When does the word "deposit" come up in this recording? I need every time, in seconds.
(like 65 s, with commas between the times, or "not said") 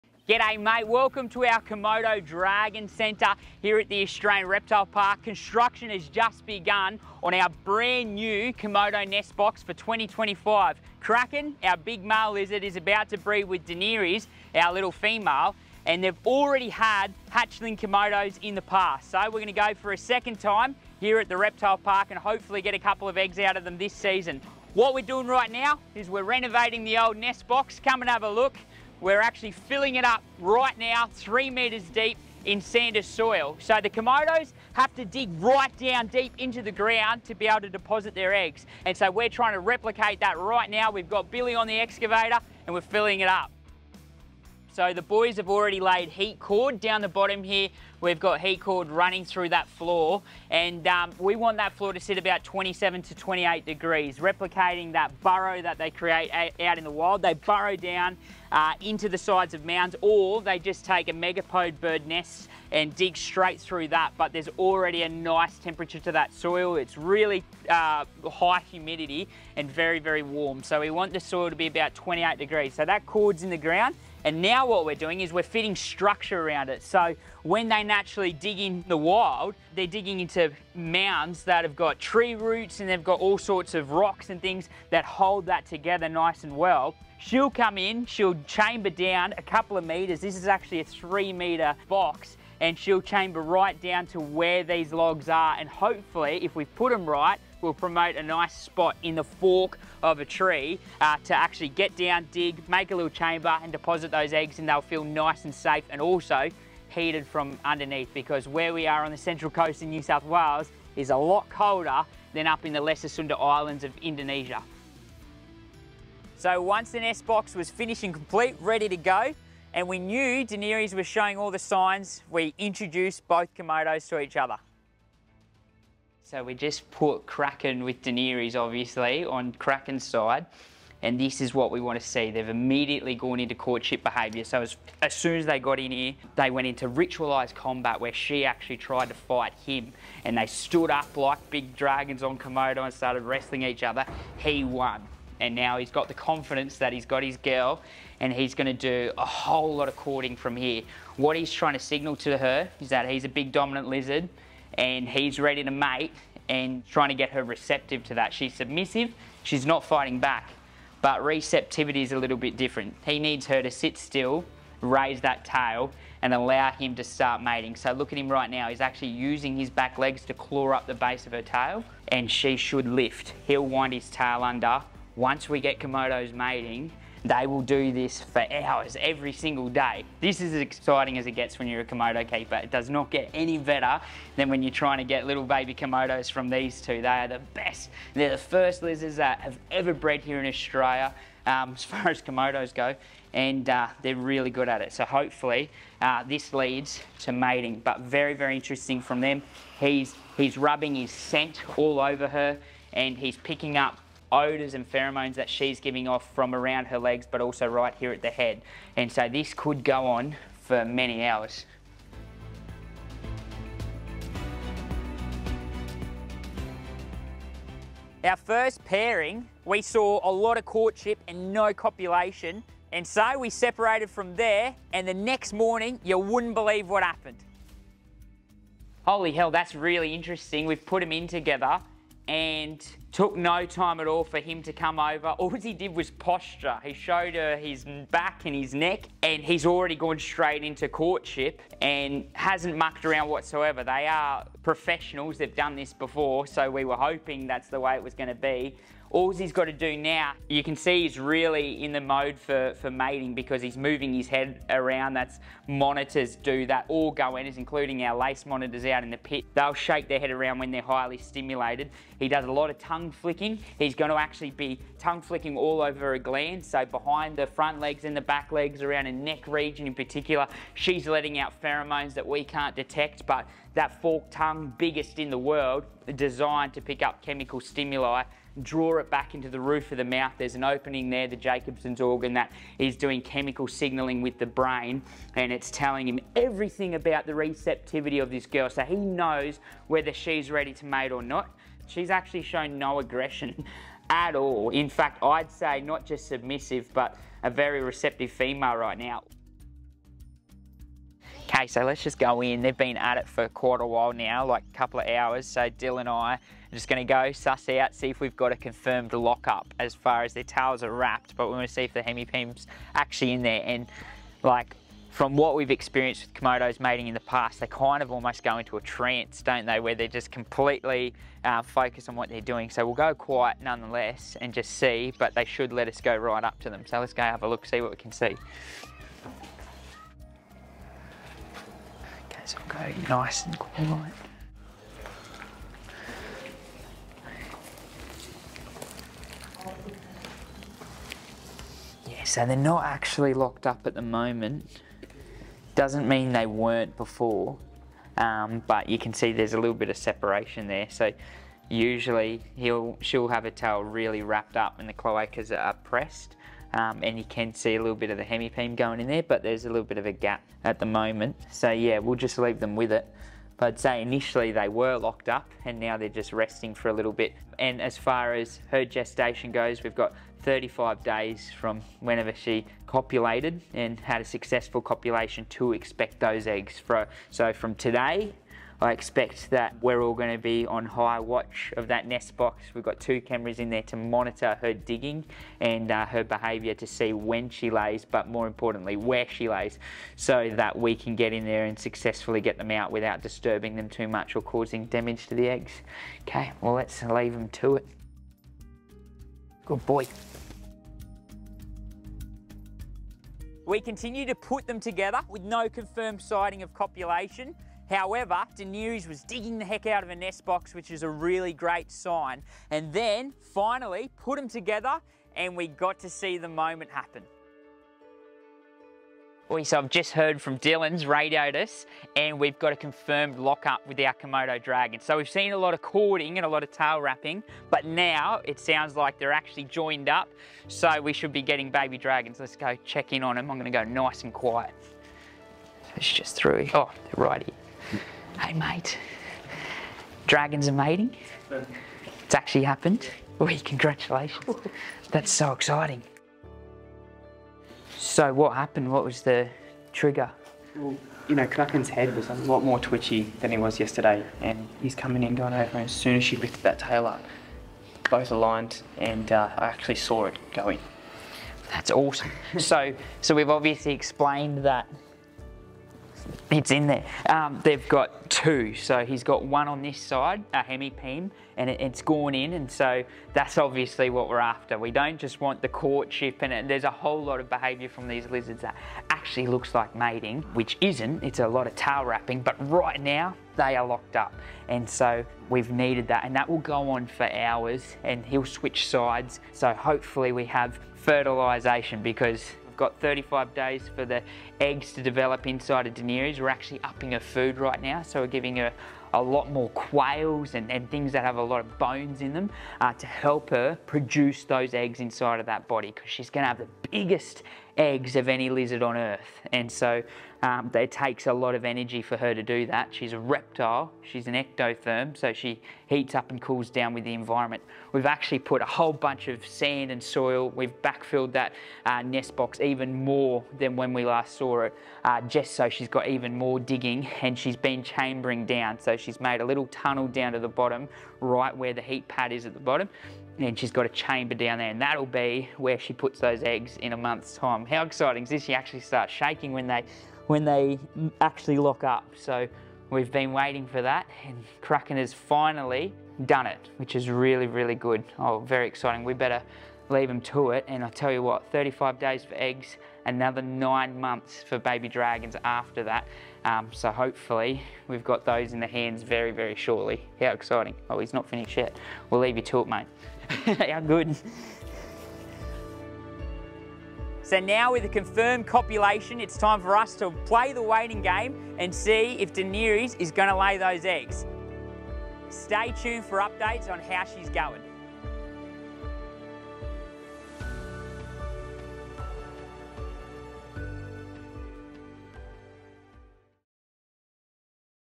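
37 s, 103 s.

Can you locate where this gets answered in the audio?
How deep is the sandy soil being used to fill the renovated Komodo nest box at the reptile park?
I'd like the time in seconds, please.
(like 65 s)
31 s.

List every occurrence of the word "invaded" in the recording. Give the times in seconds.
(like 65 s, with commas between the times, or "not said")
not said.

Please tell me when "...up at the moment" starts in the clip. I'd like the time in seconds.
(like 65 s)
343 s.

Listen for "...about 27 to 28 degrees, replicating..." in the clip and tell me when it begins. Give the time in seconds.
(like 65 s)
52 s.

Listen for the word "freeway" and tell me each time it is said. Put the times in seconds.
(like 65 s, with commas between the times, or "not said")
not said.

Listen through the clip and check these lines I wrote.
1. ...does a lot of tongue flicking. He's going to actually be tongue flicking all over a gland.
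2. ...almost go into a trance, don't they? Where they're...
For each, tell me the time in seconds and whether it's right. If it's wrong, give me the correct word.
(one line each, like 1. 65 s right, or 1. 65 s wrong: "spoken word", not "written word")
1. 262 s right
2. 318 s right.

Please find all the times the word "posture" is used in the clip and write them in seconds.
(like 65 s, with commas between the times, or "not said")
236 s.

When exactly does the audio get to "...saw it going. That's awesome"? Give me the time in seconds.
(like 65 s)
459 s.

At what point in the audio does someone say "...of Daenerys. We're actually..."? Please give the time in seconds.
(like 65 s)
495 s.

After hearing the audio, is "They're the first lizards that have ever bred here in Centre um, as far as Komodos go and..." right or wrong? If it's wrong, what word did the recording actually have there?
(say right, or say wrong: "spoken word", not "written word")
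wrong: "Australia", not "Centre".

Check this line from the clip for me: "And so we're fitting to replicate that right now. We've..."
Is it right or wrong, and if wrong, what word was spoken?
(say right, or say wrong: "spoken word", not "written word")
wrong: "trying", not "fitting".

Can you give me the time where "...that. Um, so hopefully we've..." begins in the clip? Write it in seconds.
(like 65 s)
555 s.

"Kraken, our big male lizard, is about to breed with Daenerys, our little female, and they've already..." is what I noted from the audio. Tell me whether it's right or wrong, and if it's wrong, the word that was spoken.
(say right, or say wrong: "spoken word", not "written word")
right.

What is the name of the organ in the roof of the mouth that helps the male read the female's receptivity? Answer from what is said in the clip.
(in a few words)
Jacobson's organ.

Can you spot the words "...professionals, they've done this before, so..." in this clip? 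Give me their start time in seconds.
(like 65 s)
244 s.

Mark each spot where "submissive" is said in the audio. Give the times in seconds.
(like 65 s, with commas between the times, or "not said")
158 s, 296 s.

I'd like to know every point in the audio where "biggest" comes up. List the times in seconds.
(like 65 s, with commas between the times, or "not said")
274 s, 506 s.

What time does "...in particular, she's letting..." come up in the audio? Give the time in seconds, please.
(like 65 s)
269 s.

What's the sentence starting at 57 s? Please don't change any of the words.
They burrow down uh, into the sides of mounds or they just take a megapode bird nest and dig straight through that.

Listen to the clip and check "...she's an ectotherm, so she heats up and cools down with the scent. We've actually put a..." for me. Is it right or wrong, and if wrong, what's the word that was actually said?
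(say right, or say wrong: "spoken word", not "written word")
wrong: "environment", not "scent".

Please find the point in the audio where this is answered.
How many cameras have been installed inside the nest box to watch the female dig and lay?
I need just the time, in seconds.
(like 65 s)
382 s.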